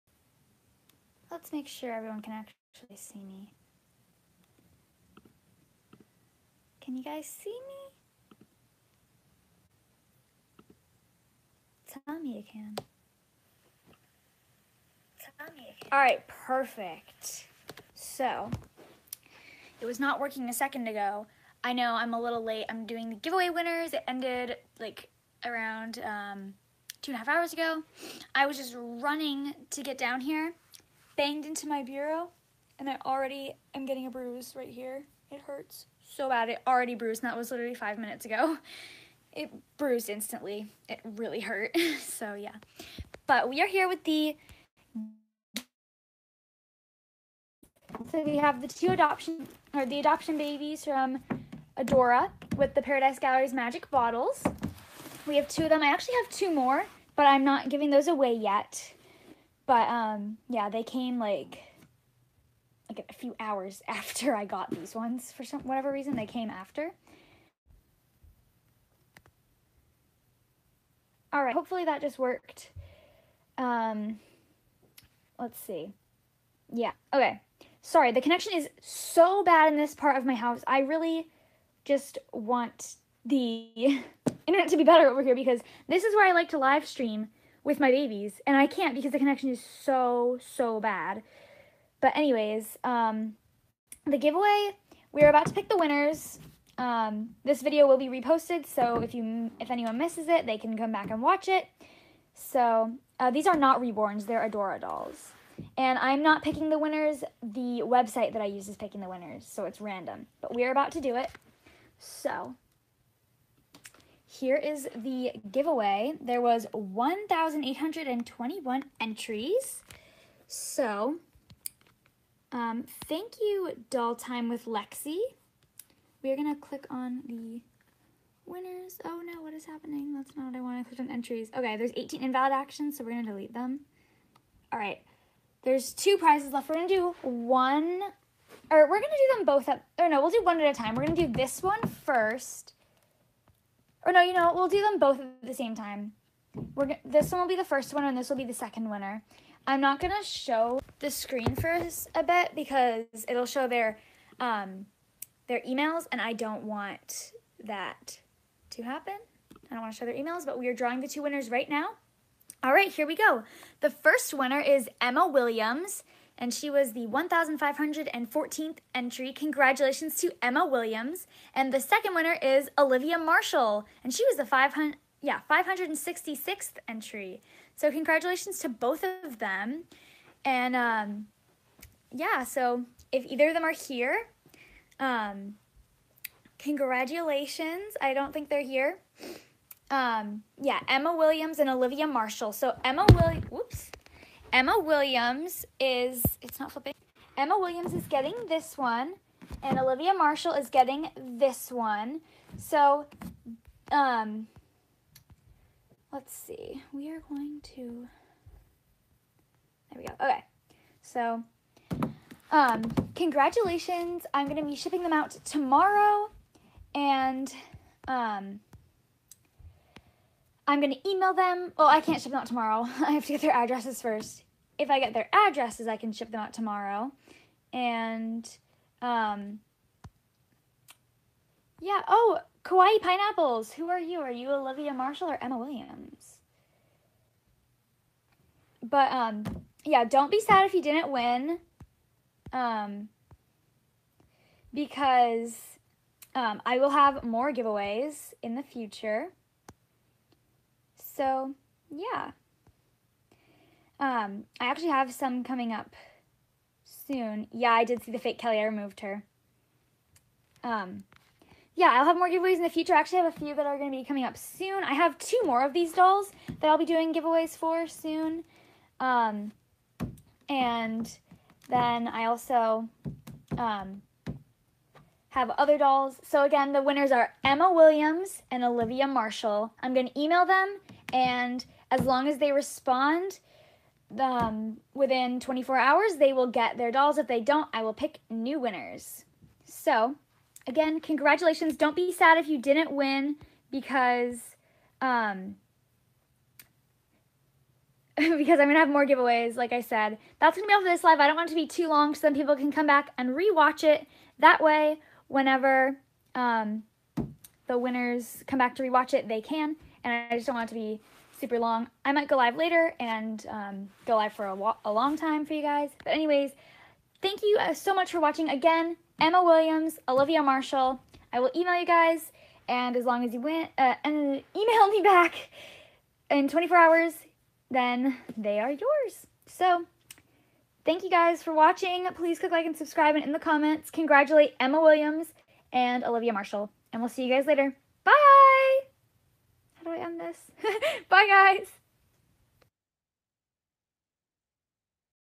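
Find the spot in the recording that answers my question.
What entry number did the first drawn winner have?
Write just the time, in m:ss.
2:47.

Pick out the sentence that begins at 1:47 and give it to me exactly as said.
The website that I use is picking the winners, so it's random.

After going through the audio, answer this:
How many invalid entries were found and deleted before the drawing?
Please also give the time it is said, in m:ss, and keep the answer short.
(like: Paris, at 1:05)
18, at 2:11.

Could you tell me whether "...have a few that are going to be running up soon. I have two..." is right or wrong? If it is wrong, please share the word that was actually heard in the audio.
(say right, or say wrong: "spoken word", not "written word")
wrong: "coming", not "running".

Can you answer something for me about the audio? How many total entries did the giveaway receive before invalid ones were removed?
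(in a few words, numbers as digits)
1,821.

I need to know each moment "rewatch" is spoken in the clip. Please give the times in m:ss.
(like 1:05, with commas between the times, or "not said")
5:03, 5:08.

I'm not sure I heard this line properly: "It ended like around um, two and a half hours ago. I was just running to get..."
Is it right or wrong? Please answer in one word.
right.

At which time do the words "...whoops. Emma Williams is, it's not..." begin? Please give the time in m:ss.
3:13.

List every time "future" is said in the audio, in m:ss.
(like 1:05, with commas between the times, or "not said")
4:08, 4:22.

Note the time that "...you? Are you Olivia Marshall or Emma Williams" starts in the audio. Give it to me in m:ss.
3:53.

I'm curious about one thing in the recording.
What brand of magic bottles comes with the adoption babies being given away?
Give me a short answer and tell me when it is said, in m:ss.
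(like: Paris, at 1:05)
Paradise Galleries, at 0:52.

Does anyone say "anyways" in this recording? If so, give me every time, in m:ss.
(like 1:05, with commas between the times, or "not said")
1:32, 5:16.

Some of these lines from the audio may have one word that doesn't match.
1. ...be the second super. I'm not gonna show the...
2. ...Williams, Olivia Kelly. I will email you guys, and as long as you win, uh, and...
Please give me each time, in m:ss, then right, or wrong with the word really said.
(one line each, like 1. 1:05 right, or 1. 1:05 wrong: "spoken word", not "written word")
1. 2:28 wrong: "winner", not "super"
2. 5:19 wrong: "Marshall", not "Kelly".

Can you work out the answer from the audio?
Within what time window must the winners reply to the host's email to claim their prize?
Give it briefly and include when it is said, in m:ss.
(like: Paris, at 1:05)
24 hours, at 4:44.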